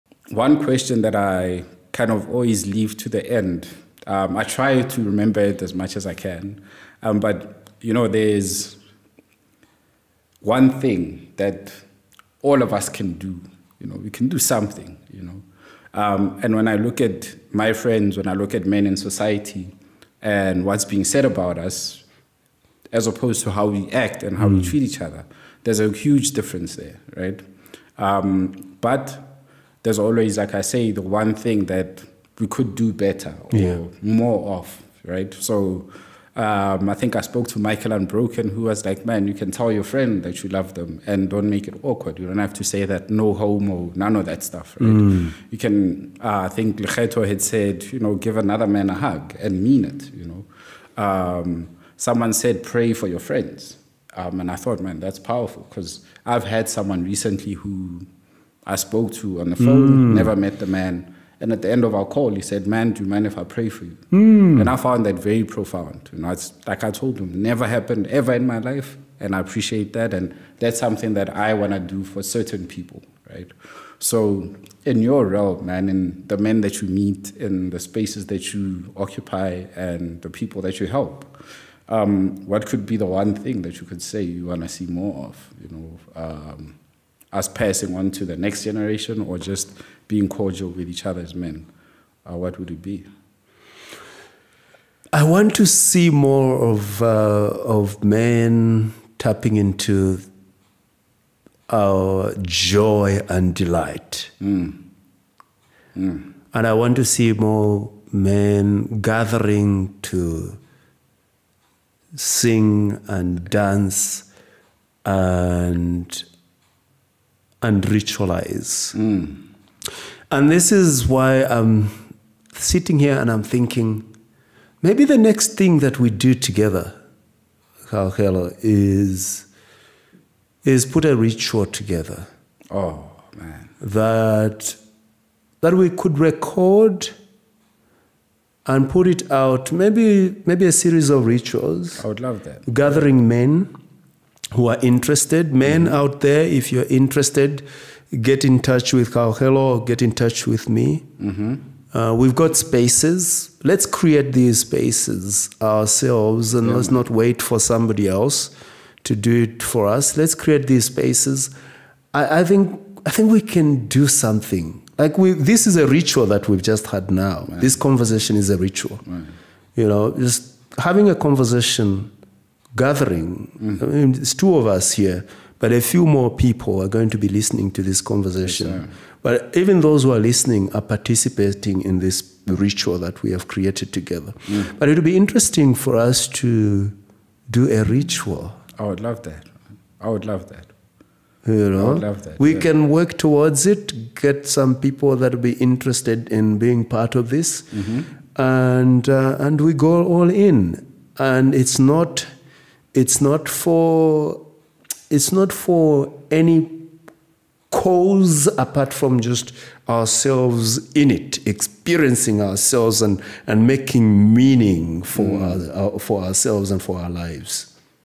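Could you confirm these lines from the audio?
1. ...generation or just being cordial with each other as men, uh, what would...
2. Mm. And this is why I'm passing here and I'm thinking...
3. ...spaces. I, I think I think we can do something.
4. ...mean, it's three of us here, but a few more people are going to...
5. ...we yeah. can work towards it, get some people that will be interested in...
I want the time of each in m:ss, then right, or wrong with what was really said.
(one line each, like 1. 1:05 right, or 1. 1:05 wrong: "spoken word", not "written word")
1. 1:28 right
2. 1:58 wrong: "sitting", not "passing"
3. 2:40 right
4. 2:53 wrong: "two", not "three"
5. 3:12 right.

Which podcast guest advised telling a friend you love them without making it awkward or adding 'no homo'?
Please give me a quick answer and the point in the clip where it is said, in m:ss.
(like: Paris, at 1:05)
Michael Unbroken, at 0:37.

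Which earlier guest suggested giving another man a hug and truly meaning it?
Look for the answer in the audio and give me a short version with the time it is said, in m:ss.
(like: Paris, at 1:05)
Lecheto, at 0:46.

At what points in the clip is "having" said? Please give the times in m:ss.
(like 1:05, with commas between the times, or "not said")
2:50.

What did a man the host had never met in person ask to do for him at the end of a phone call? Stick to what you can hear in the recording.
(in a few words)
pray for you.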